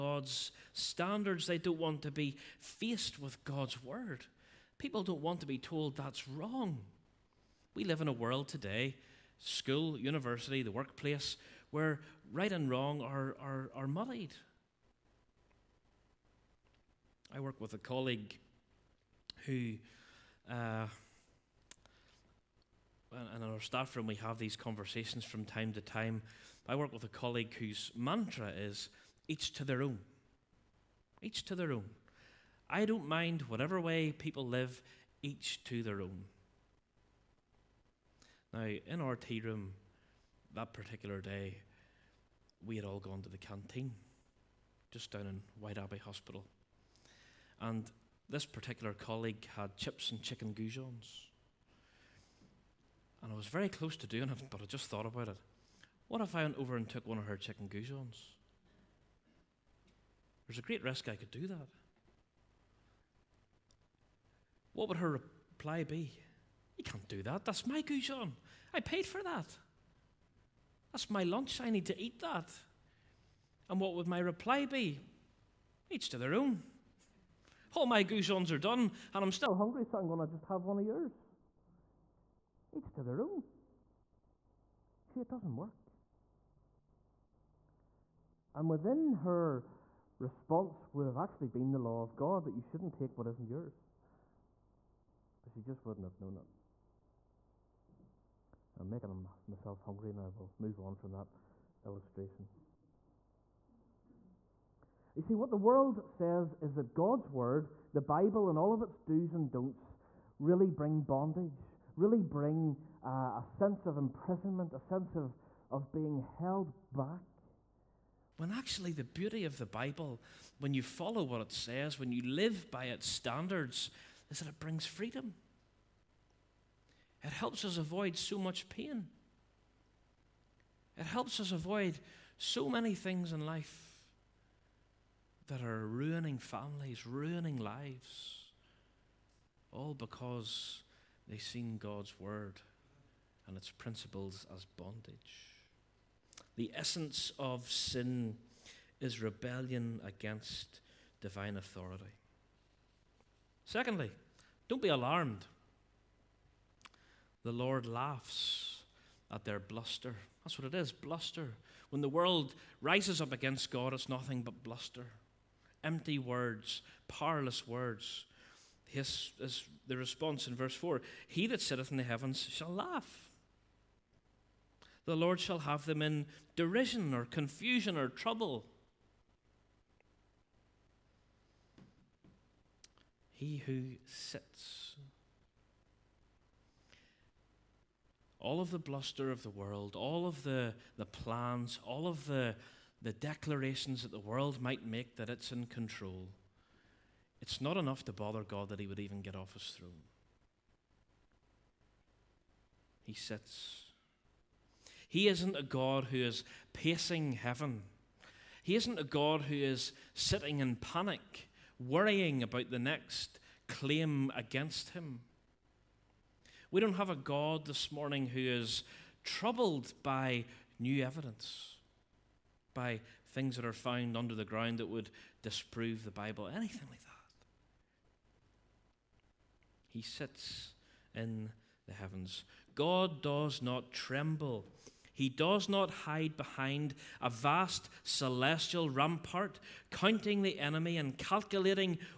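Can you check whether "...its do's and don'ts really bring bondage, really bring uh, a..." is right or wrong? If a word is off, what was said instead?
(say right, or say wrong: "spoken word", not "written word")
right.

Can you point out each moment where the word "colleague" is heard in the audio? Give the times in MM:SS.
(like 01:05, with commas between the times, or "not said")
00:17, 00:27, 00:48.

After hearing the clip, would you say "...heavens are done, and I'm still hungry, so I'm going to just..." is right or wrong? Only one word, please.
wrong.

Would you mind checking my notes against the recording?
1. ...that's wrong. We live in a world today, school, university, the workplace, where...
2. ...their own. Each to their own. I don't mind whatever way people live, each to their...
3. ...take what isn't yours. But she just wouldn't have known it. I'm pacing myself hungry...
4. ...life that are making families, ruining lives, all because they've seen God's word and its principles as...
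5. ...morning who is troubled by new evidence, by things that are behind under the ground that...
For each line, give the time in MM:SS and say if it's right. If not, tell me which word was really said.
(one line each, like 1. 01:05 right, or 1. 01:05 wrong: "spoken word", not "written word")
1. 00:05 right
2. 00:29 right
3. 01:32 wrong: "making", not "pacing"
4. 02:13 wrong: "ruining", not "making"
5. 03:37 wrong: "found", not "behind".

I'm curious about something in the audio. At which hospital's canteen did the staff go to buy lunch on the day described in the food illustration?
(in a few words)
Whiteabbey Hospital.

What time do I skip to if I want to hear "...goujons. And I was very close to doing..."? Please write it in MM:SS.
00:50.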